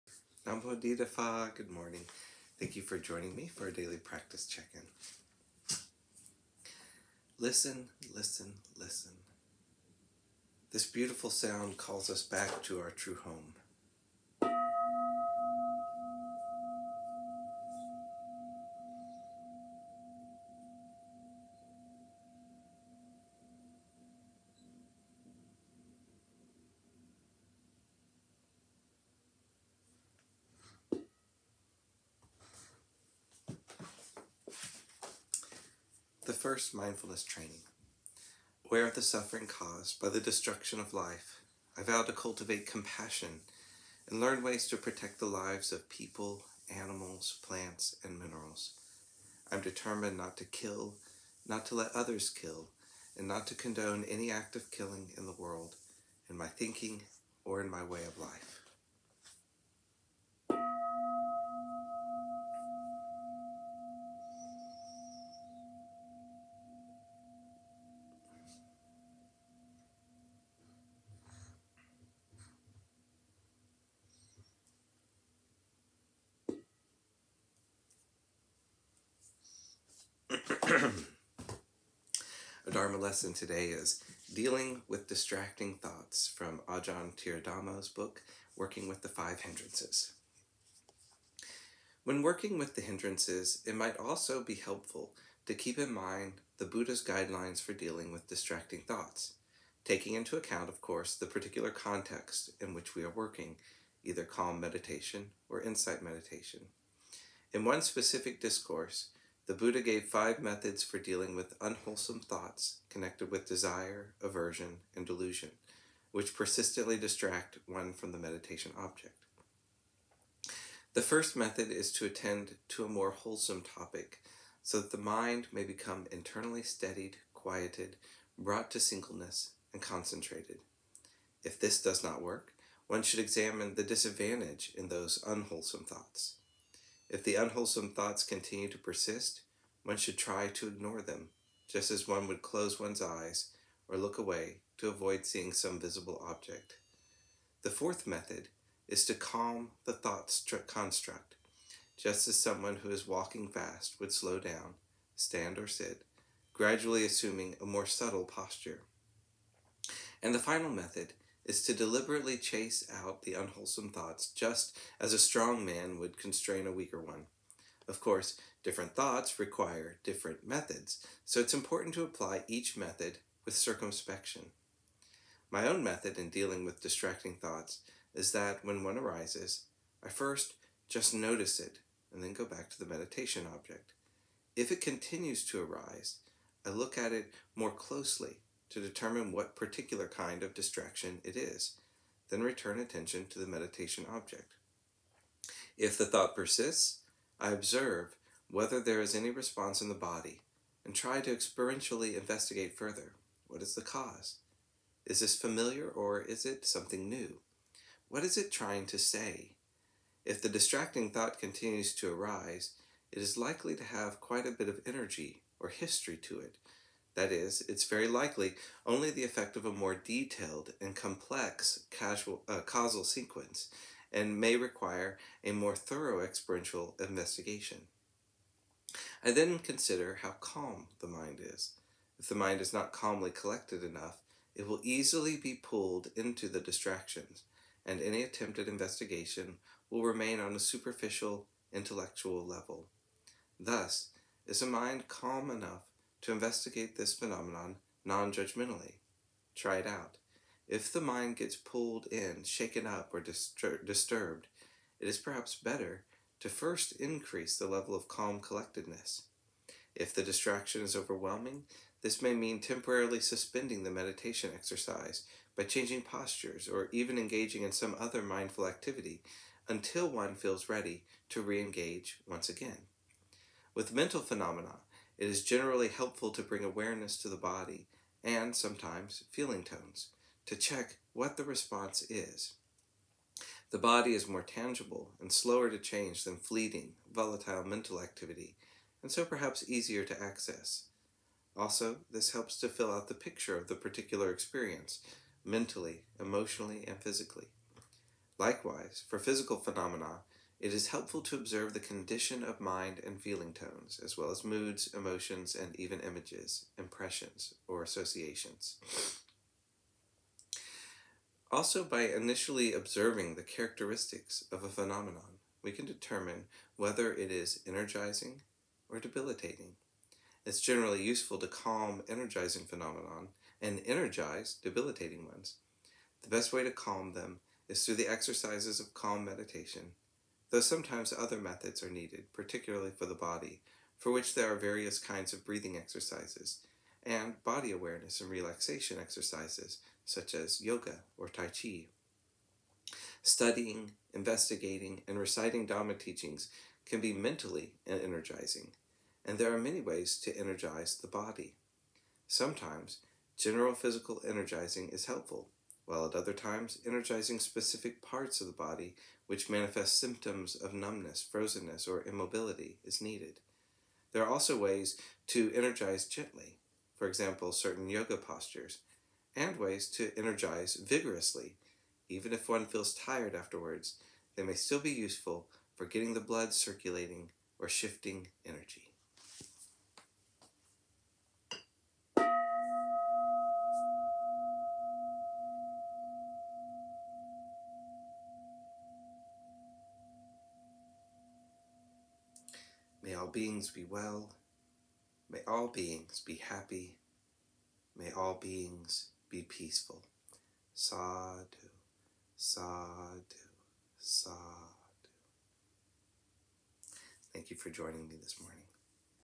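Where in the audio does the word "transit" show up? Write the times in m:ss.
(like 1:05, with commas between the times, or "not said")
not said.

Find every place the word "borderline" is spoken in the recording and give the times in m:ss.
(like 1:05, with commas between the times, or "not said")
not said.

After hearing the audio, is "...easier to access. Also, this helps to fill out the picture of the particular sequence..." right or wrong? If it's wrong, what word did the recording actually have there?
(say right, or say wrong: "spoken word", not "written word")
wrong: "experience", not "sequence".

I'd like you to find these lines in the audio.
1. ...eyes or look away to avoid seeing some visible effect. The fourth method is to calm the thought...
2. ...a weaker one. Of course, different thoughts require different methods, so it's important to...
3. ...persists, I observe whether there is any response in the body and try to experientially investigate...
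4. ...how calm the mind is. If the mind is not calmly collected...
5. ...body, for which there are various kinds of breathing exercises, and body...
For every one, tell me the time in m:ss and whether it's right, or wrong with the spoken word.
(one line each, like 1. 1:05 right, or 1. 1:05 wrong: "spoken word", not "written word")
1. 2:23 wrong: "object", not "effect"
2. 2:46 right
3. 3:16 right
4. 3:50 right
5. 5:33 right.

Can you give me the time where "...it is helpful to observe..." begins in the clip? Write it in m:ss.
5:00.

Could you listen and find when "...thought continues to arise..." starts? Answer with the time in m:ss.
3:31.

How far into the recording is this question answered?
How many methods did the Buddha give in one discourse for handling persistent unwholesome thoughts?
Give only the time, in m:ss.
1:50.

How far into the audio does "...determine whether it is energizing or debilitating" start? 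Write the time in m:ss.
5:15.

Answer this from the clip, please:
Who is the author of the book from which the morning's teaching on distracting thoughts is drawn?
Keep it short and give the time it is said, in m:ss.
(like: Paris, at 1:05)
Ajahn Thiradhammo, at 1:26.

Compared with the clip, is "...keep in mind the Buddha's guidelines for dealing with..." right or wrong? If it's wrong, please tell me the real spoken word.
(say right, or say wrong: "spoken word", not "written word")
right.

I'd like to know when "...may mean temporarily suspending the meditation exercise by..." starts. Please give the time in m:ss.
4:22.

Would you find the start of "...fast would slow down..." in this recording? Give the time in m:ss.
2:33.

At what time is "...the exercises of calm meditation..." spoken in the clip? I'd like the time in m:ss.
5:27.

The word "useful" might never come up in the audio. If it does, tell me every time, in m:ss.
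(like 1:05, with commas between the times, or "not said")
5:21, 6:14.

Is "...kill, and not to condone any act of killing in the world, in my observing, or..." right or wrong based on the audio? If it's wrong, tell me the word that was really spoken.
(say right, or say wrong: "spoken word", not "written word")
wrong: "thinking", not "observing".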